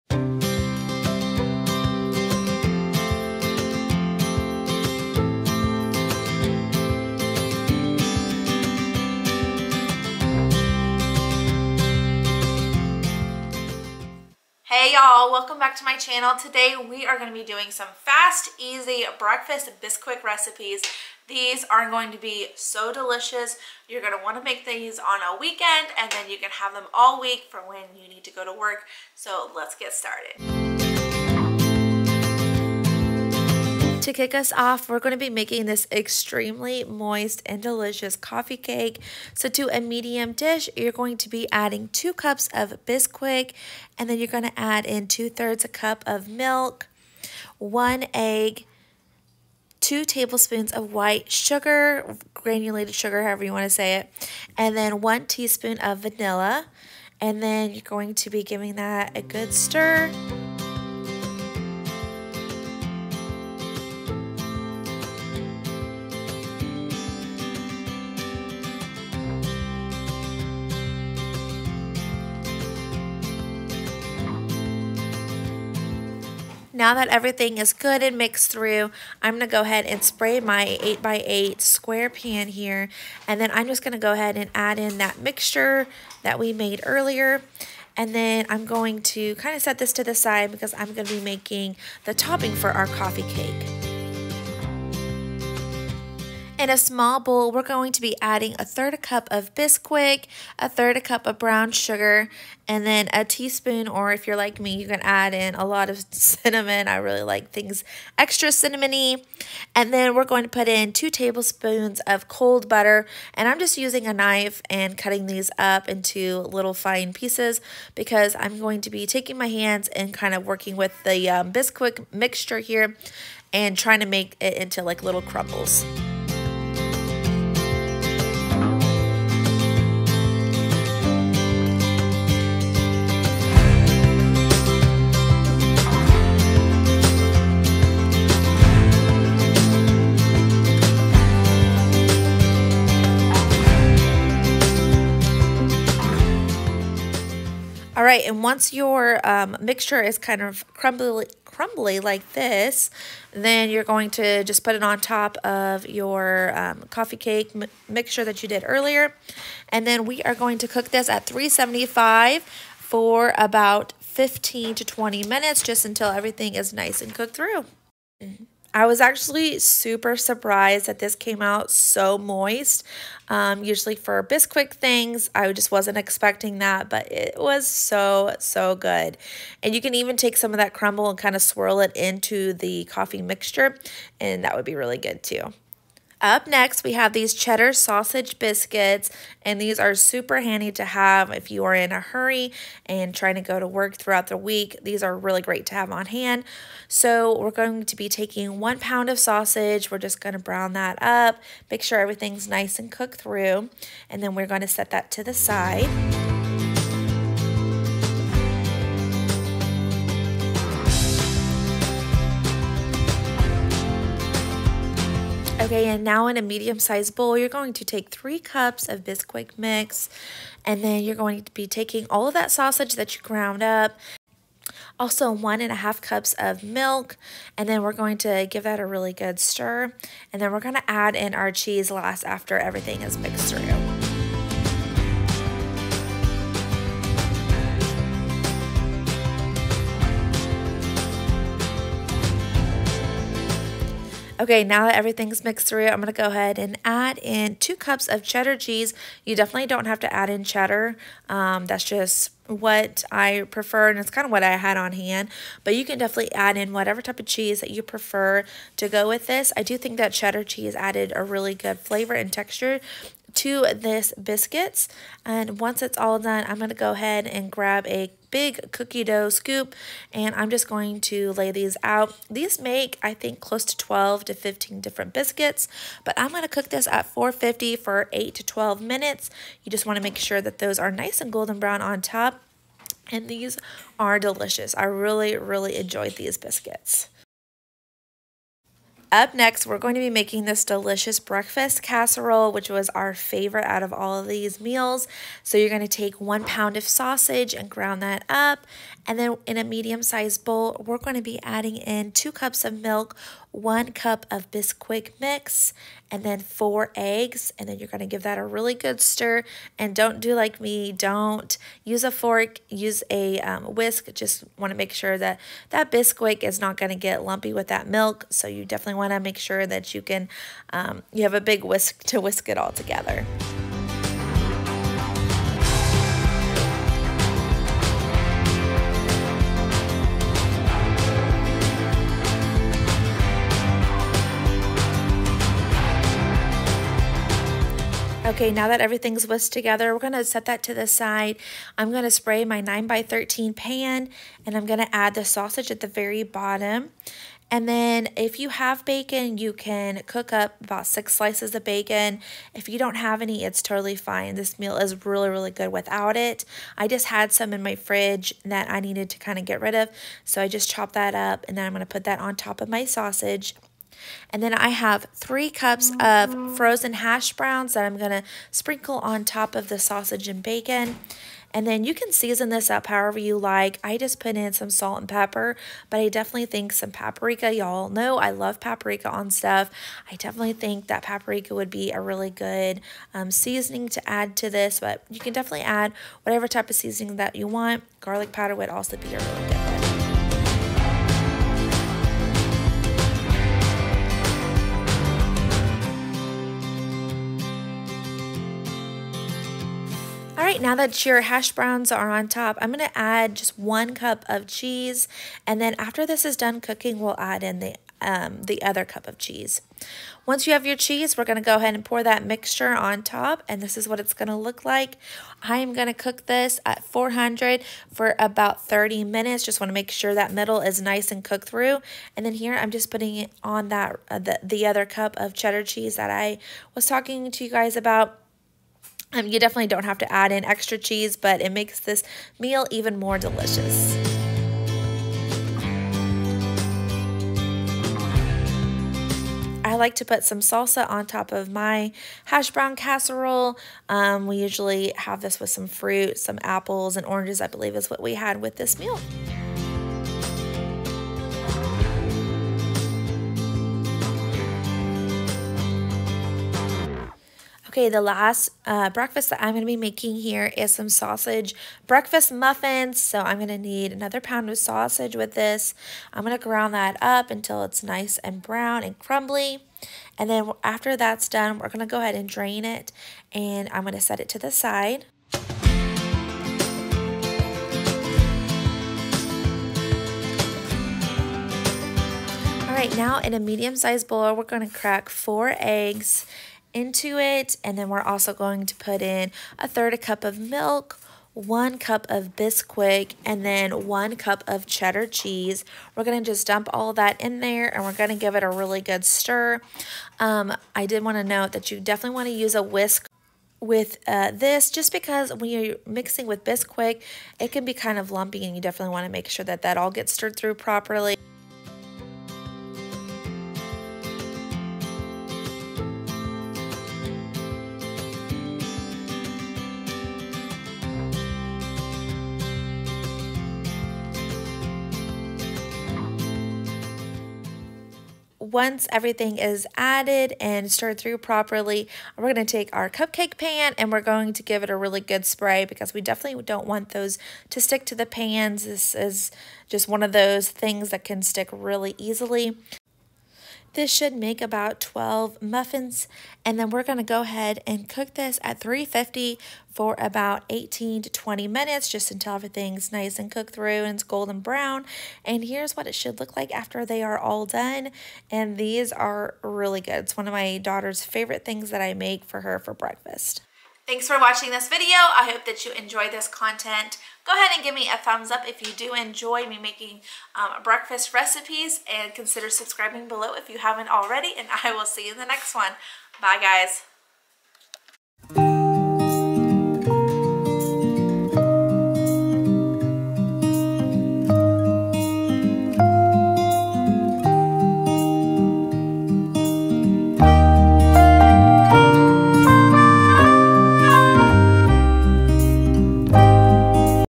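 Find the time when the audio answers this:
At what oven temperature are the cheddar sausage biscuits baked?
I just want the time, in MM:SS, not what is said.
04:37.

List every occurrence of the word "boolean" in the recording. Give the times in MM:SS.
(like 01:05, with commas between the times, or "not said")
not said.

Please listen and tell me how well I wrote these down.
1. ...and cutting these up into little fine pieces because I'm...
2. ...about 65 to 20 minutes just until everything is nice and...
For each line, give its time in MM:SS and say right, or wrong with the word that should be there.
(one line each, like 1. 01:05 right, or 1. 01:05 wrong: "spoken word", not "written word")
1. 01:54 right
2. 02:43 wrong: "15", not "65".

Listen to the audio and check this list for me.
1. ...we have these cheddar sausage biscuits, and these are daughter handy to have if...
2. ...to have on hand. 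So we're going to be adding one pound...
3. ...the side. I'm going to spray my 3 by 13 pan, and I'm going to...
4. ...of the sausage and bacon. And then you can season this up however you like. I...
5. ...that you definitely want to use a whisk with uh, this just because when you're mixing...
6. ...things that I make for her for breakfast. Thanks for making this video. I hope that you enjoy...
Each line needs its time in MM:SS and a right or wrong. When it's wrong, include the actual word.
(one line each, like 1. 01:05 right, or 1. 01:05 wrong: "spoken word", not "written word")
1. 03:06 wrong: "super", not "daughter"
2. 03:15 wrong: "taking", not "adding"
3. 05:40 wrong: "9", not "3"
4. 06:09 right
5. 08:21 right
6. 09:21 wrong: "watching", not "making".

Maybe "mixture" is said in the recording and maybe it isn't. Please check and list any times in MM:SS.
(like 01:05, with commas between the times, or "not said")
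01:25, 02:02, 02:29, 02:37, 03:03, 06:52.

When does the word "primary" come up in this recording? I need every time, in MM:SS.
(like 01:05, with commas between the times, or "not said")
not said.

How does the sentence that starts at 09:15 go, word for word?
And here's what it should look like after they are all done.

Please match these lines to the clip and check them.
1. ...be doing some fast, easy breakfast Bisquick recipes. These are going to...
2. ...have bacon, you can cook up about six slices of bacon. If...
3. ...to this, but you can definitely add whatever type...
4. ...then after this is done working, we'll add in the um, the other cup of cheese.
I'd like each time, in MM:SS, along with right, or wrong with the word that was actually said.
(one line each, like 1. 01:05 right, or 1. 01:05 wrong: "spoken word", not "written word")
1. 00:17 right
2. 05:48 right
3. 06:24 right
4. 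06:45 wrong: "cooking", not "working".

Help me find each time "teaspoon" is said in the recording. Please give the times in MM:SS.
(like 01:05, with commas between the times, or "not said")
00:55, 01:43.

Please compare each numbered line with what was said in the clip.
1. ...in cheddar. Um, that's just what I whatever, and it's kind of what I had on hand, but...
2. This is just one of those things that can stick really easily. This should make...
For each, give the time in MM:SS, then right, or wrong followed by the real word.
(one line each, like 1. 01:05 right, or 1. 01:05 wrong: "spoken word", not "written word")
1. 04:10 wrong: "prefer", not "whatever"
2. 08:58 right.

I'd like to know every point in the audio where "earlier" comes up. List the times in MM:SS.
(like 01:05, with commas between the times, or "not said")
01:26, 02:38.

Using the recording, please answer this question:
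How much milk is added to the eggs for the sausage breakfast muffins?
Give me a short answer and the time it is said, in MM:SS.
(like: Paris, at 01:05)
1/3 cup, at 08:09.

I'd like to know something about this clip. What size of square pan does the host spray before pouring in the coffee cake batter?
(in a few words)
8x8.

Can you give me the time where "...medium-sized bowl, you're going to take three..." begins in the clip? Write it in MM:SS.
03:36.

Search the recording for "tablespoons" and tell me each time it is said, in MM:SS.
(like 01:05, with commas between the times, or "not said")
00:50, 01:51.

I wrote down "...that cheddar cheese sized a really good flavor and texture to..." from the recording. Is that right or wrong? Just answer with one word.
wrong.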